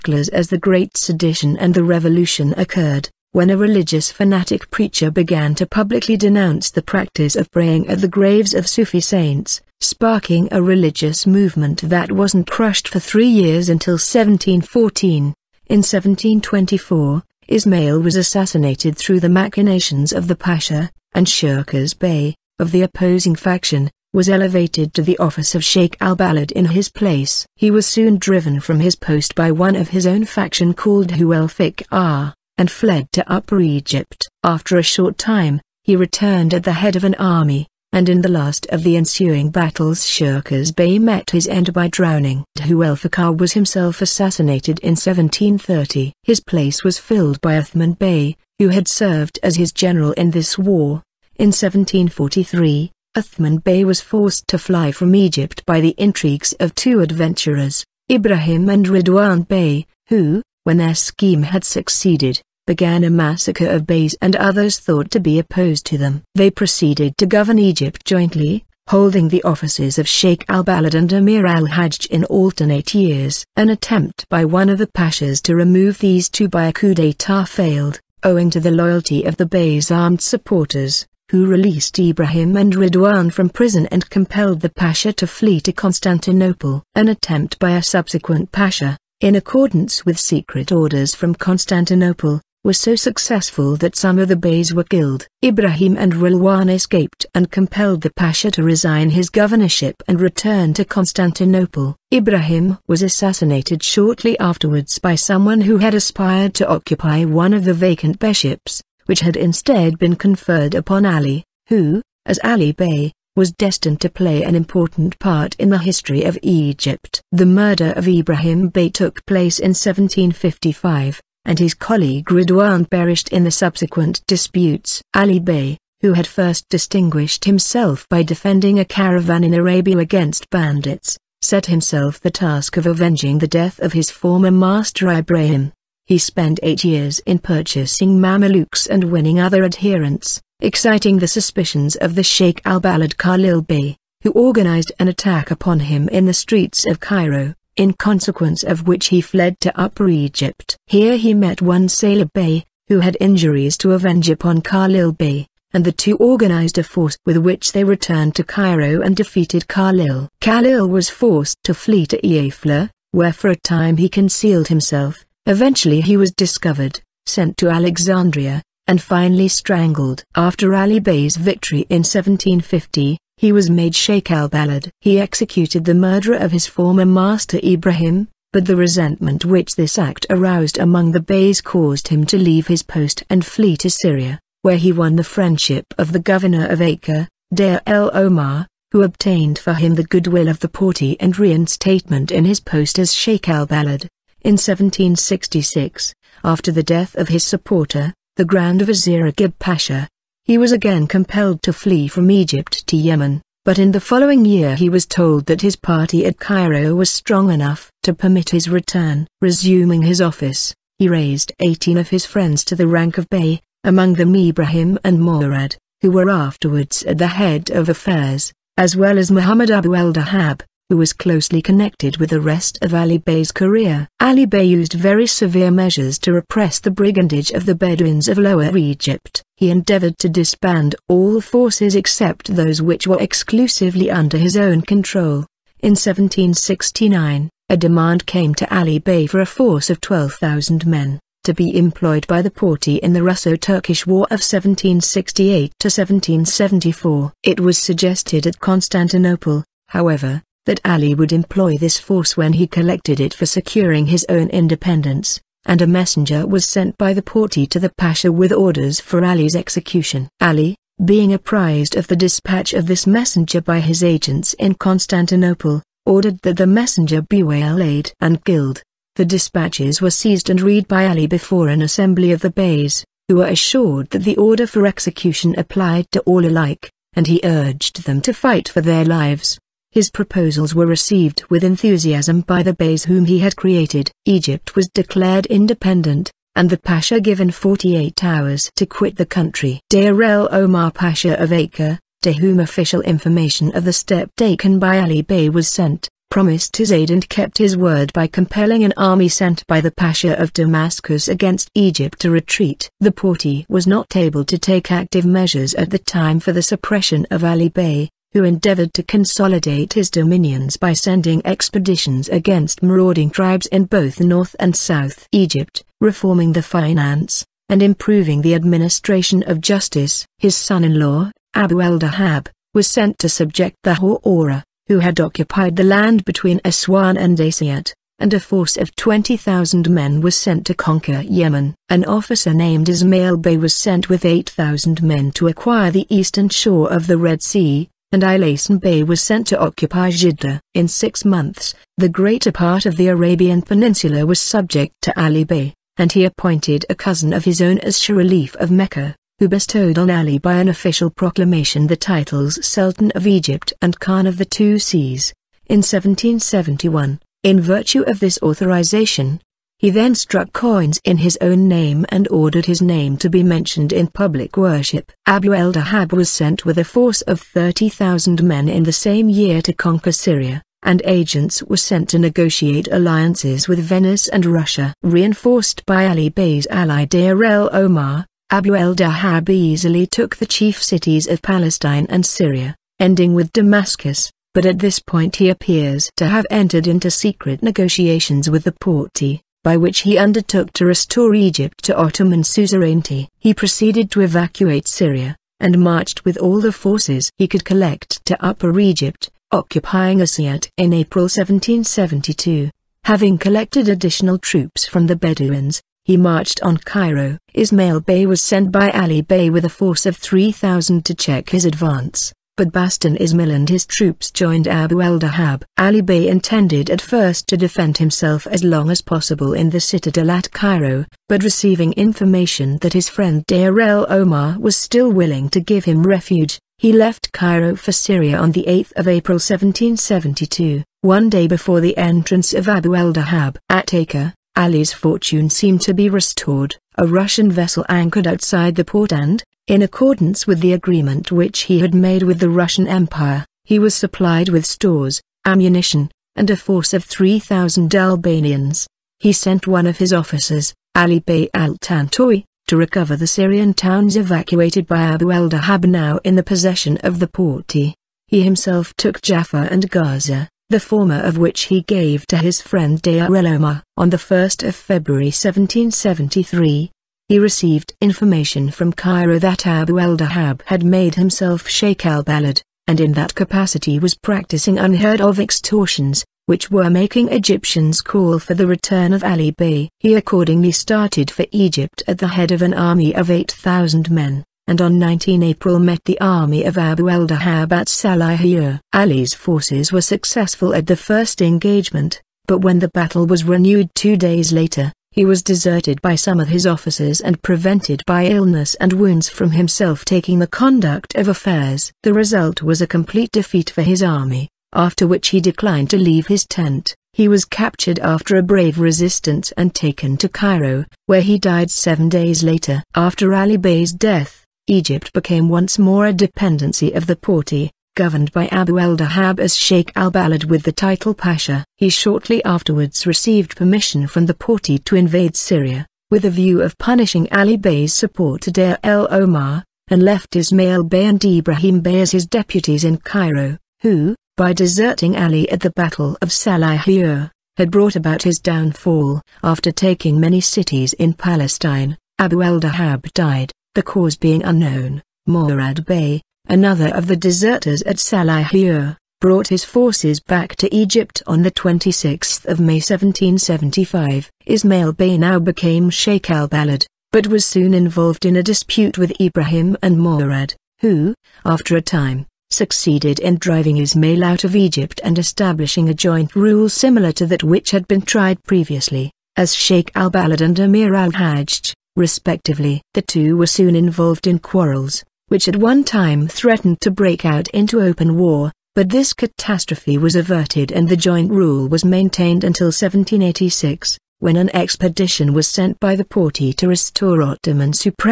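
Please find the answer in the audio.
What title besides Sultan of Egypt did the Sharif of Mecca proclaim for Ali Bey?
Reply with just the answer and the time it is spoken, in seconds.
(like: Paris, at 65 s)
Khan of the Two Seas, at 353 s.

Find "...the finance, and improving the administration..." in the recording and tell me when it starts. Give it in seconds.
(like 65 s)
316 s.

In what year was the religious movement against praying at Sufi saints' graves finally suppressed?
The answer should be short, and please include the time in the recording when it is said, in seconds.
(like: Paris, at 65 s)
1714, at 13 s.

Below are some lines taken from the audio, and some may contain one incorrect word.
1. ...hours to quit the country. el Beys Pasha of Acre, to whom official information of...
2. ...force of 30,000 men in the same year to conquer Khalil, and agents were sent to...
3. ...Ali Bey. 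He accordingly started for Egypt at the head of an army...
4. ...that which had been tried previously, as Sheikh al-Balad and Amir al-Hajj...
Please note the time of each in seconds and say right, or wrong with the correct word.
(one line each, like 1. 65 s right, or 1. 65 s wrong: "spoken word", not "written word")
1. 288 s wrong: "Omar", not "Beys"
2. 366 s wrong: "Syria", not "Khalil"
3. 479 s right
4. 567 s right.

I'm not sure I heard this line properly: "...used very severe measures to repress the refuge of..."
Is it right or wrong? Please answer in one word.
wrong.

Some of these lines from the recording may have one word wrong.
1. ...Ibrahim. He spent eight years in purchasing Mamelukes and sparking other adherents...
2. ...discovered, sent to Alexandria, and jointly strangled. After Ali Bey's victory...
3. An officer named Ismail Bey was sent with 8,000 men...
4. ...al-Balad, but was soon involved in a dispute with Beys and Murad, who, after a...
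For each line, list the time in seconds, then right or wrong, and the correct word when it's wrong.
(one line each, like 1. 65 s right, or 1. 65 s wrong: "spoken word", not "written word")
1. 135 s wrong: "winning", not "sparking"
2. 166 s wrong: "finally", not "jointly"
3. 331 s right
4. 556 s wrong: "Ibrahim", not "Beys".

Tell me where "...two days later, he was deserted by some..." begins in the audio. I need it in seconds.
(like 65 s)
493 s.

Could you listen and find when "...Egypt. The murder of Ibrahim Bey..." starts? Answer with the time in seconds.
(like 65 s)
116 s.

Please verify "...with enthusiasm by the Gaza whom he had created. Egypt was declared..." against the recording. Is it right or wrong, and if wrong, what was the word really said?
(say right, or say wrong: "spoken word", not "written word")
wrong: "Beys", not "Gaza".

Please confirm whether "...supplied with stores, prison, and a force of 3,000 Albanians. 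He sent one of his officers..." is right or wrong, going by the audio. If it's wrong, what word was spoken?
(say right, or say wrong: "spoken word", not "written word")
wrong: "ammunition", not "prison".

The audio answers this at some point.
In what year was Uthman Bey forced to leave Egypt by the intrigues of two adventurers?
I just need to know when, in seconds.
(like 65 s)
51 s.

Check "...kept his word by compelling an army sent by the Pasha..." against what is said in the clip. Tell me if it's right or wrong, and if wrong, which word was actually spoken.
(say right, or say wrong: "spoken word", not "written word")
right.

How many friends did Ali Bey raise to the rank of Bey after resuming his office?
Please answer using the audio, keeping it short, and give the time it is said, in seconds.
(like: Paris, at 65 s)
18, at 211 s.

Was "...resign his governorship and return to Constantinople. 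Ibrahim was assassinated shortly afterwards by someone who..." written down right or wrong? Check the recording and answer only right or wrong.
right.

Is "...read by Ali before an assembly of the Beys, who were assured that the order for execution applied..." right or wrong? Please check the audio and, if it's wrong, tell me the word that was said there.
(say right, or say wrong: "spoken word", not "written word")
right.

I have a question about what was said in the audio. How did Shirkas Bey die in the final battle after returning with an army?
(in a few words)
By drowning.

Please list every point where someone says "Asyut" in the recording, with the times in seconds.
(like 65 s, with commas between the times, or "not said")
327 s, 400 s.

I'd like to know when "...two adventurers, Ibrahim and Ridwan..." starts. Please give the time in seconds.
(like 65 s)
56 s.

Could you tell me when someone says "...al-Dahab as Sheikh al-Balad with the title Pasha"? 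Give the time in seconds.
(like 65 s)
518 s.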